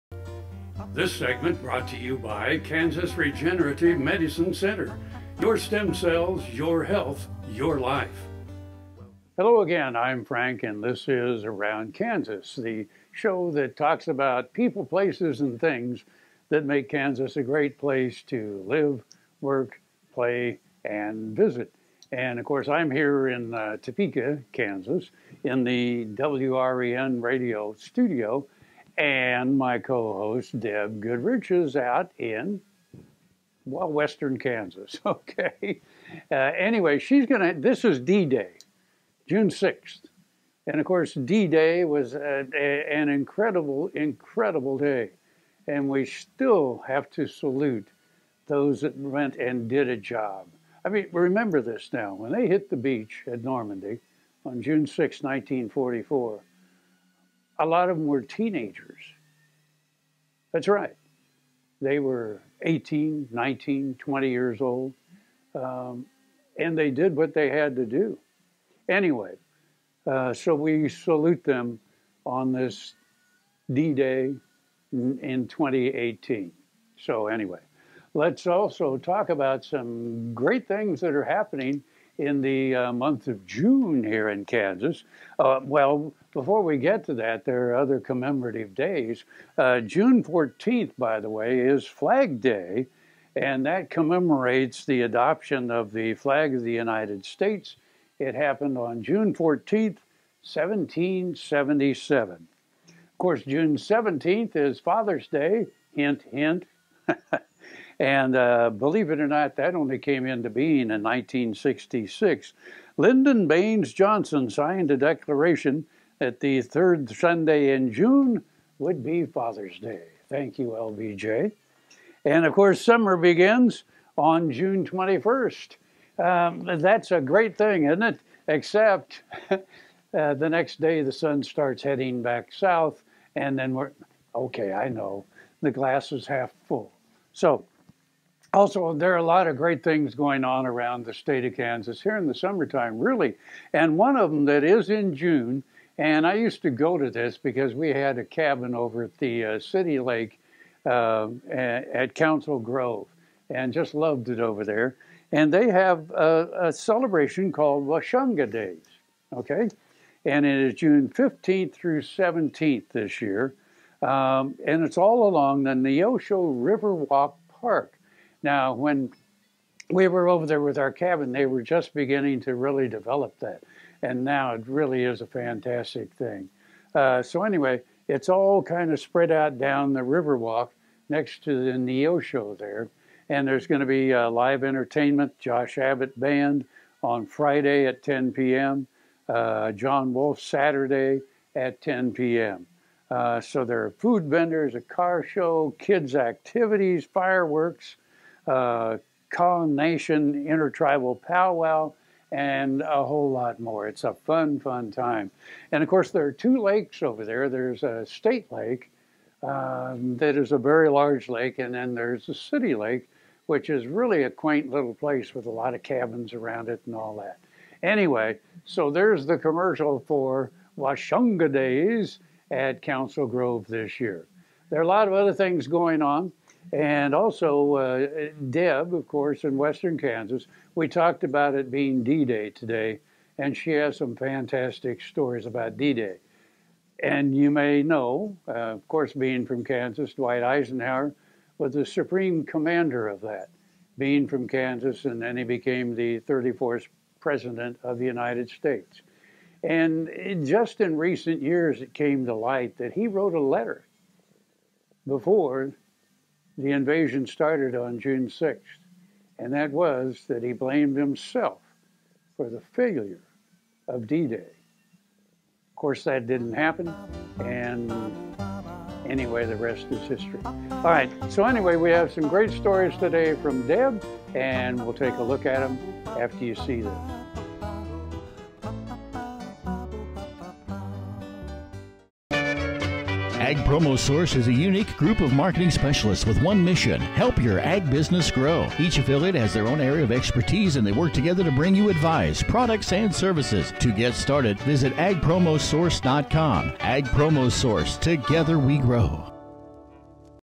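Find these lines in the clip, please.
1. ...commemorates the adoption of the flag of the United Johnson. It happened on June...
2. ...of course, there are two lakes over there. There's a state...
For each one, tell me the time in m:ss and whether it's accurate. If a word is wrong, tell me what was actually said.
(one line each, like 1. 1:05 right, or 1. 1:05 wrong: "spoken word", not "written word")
1. 1:33 wrong: "States", not "Johnson"
2. 3:25 right.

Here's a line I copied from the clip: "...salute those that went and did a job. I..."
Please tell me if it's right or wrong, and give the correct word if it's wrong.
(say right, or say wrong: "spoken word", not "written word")
right.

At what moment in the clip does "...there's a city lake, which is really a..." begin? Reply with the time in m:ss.
3:31.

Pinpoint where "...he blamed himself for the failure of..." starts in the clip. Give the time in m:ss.
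4:20.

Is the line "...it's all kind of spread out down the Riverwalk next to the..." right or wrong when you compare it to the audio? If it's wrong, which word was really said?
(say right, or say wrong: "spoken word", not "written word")
right.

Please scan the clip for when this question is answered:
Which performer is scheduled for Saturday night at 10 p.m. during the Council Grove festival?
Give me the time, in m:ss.
3:09.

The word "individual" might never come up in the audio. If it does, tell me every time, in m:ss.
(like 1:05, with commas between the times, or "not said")
not said.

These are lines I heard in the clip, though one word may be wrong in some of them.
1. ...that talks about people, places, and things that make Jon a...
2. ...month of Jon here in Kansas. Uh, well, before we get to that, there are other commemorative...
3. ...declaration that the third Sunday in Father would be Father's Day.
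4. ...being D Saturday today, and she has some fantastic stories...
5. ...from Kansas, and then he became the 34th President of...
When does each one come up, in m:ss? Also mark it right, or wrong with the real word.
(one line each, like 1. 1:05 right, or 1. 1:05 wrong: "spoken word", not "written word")
1. 0:13 wrong: "Kansas", not "Jon"
2. 1:22 wrong: "June", not "Jon"
3. 1:54 wrong: "June", not "Father"
4. 3:51 wrong: "Day", not "Saturday"
5. 4:04 right.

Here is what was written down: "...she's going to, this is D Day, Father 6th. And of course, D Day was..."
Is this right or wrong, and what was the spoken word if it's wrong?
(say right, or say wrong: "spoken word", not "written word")
wrong: "June", not "Father".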